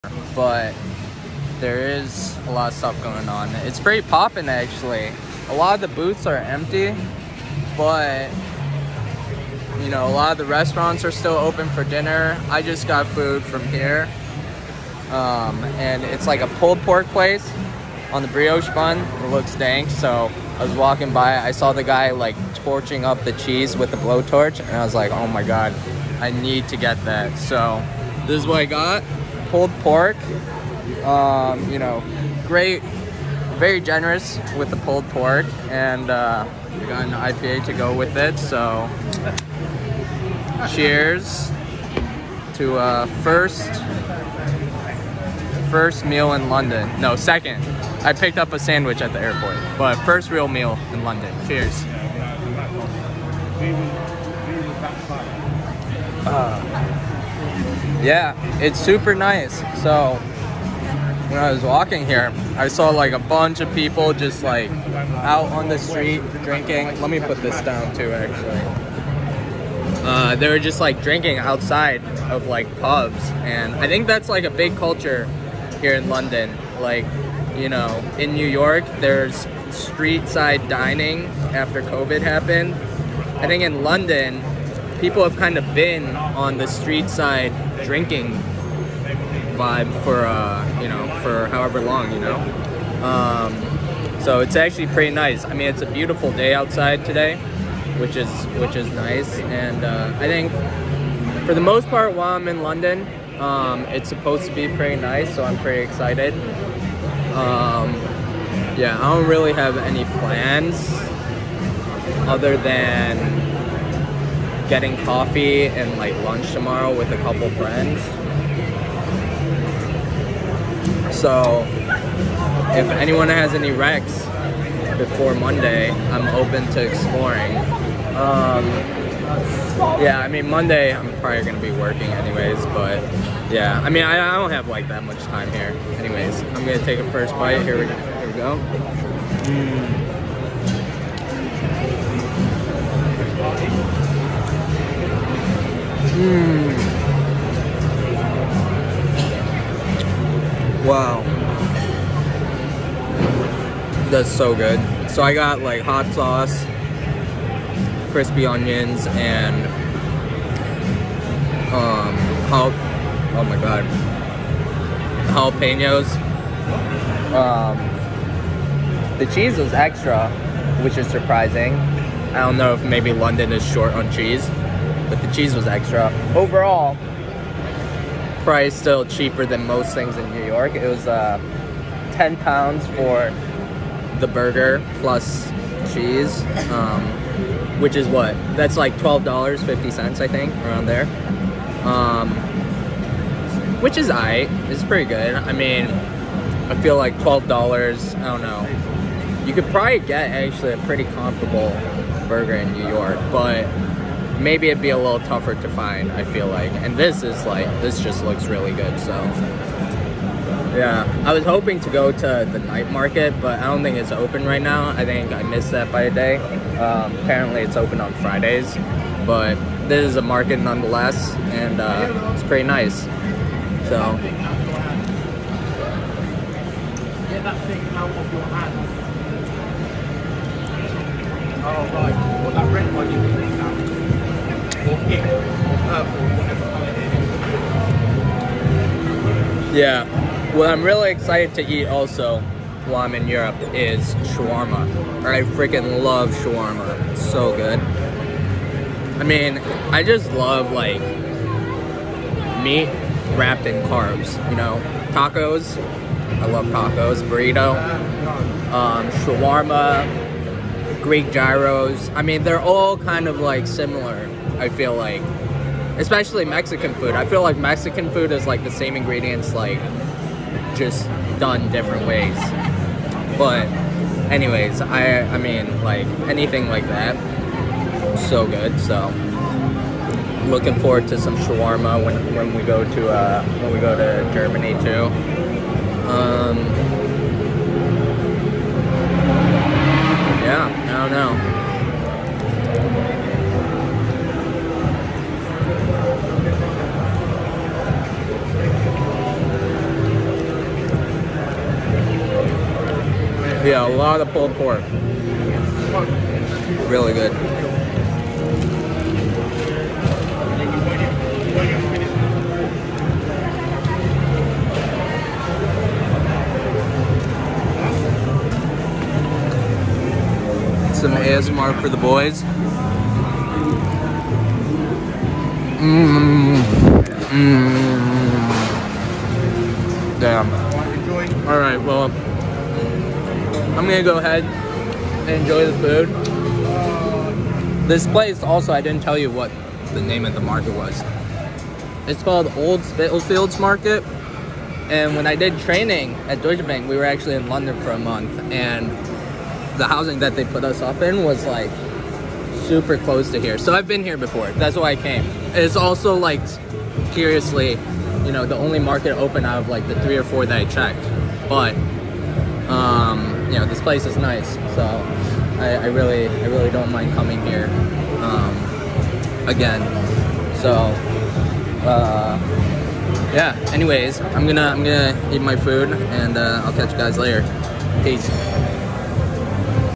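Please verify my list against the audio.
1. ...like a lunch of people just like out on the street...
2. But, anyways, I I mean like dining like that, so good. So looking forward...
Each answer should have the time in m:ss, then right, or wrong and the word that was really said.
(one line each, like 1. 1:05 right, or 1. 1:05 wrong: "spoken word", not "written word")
1. 1:02 wrong: "bunch", not "lunch"
2. 4:33 wrong: "anything", not "dining".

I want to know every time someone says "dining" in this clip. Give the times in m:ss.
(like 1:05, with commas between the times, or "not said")
1:20.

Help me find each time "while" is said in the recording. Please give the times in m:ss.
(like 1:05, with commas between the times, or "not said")
1:42, 4:02.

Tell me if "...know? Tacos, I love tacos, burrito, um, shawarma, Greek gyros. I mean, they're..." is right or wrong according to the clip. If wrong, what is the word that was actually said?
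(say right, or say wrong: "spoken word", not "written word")
right.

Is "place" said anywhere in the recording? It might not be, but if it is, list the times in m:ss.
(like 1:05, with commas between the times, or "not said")
0:17, 5:38, 6:03.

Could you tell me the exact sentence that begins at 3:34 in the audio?
I think I missed that by a day.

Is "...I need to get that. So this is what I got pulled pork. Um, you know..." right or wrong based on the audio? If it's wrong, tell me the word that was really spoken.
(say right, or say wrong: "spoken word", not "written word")
right.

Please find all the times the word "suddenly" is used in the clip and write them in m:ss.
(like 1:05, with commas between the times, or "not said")
not said.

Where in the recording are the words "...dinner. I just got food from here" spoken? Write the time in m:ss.
0:11.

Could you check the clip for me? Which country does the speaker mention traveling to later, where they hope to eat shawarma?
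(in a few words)
Germany.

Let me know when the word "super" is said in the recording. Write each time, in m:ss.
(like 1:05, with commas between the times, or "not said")
0:58, 5:52.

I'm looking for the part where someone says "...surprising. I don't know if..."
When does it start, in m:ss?
2:51.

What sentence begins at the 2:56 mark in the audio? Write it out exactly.
Overall, price still cheaper than most things in New York.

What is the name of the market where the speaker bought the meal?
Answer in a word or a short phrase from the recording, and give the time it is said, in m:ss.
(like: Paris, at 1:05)
Old Spitalfields Market, at 5:42.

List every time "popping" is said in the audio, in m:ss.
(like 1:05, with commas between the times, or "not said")
0:04.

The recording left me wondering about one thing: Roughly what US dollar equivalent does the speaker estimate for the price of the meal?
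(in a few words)
$12.50.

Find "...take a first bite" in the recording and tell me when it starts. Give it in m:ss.
2:16.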